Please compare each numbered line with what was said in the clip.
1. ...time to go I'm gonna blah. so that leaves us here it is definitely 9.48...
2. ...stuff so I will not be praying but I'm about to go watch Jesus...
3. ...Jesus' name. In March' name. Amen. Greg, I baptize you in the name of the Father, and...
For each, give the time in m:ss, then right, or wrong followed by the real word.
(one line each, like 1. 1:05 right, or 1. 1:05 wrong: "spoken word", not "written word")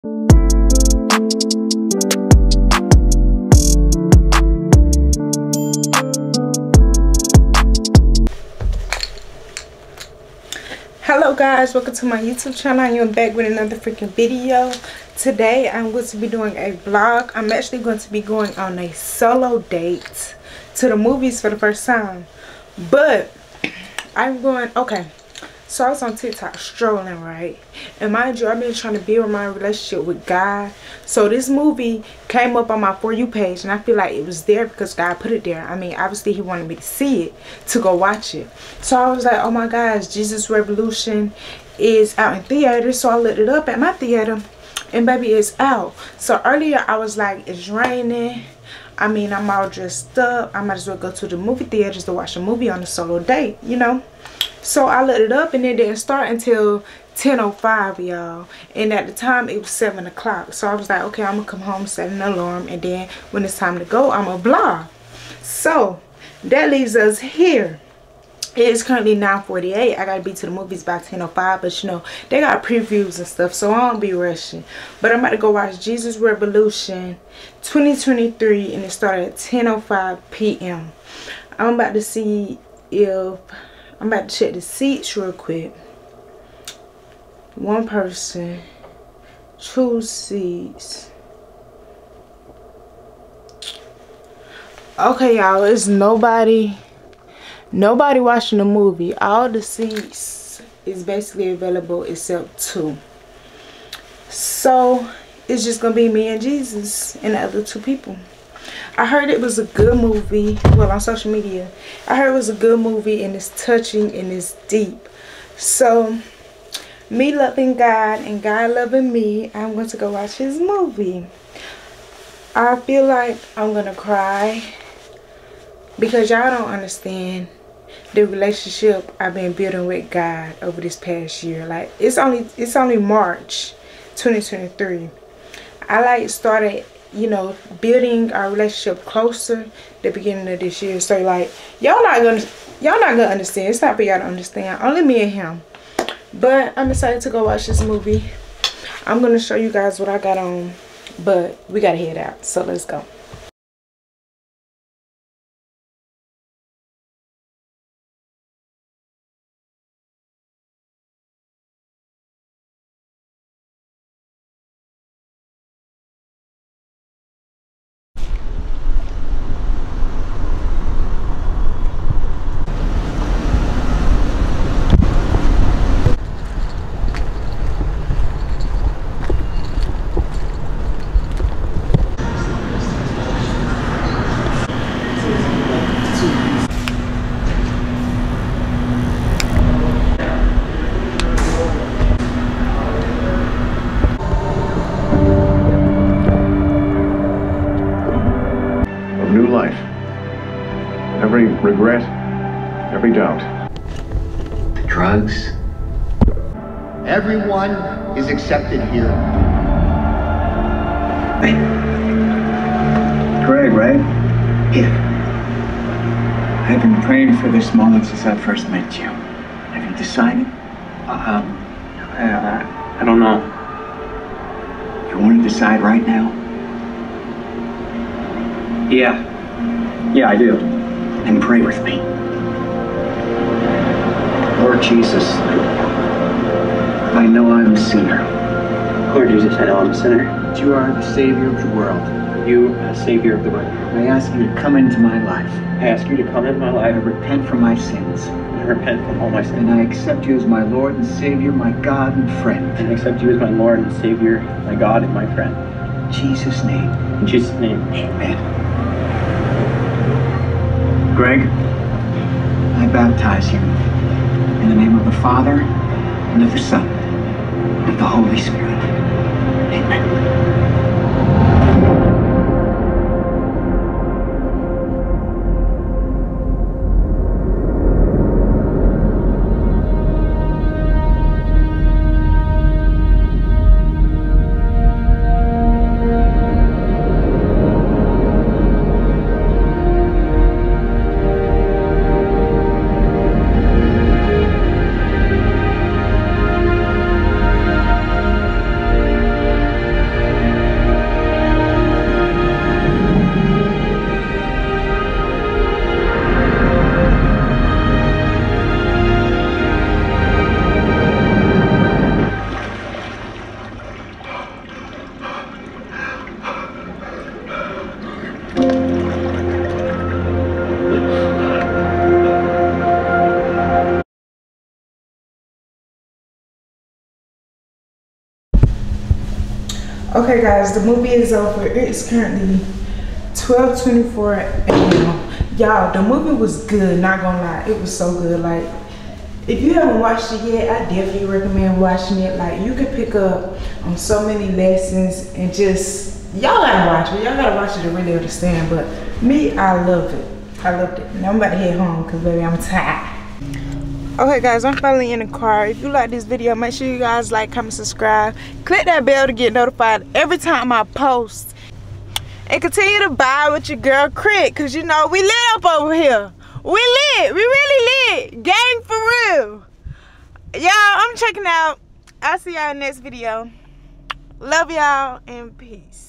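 1. 1:03 wrong: "currently", not "definitely"
2. 1:13 wrong: "rushing", not "praying"
3. 4:16 wrong: "Jesus", not "March".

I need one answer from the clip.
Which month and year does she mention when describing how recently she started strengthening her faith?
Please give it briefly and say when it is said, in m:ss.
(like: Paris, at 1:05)
March 2023, at 2:12.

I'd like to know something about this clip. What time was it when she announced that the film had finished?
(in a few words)
12:24 a.m.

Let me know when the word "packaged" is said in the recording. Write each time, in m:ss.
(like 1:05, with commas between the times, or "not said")
not said.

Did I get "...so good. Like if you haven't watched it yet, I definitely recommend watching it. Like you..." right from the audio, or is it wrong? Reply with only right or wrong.
right.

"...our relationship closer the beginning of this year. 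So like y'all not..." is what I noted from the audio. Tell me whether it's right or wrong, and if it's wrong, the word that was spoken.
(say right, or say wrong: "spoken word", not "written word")
right.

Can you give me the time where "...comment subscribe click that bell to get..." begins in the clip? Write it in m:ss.
5:57.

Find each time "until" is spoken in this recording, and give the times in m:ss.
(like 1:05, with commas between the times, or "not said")
0:56.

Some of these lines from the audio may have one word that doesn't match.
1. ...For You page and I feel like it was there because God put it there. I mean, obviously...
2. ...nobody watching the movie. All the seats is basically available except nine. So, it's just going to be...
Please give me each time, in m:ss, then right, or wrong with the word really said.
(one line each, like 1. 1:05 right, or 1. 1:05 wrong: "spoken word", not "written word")
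1. 0:32 right
2. 1:37 wrong: "two", not "nine".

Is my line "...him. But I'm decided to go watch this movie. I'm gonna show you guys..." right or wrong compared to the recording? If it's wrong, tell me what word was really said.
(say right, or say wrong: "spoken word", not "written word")
wrong: "excited", not "decided".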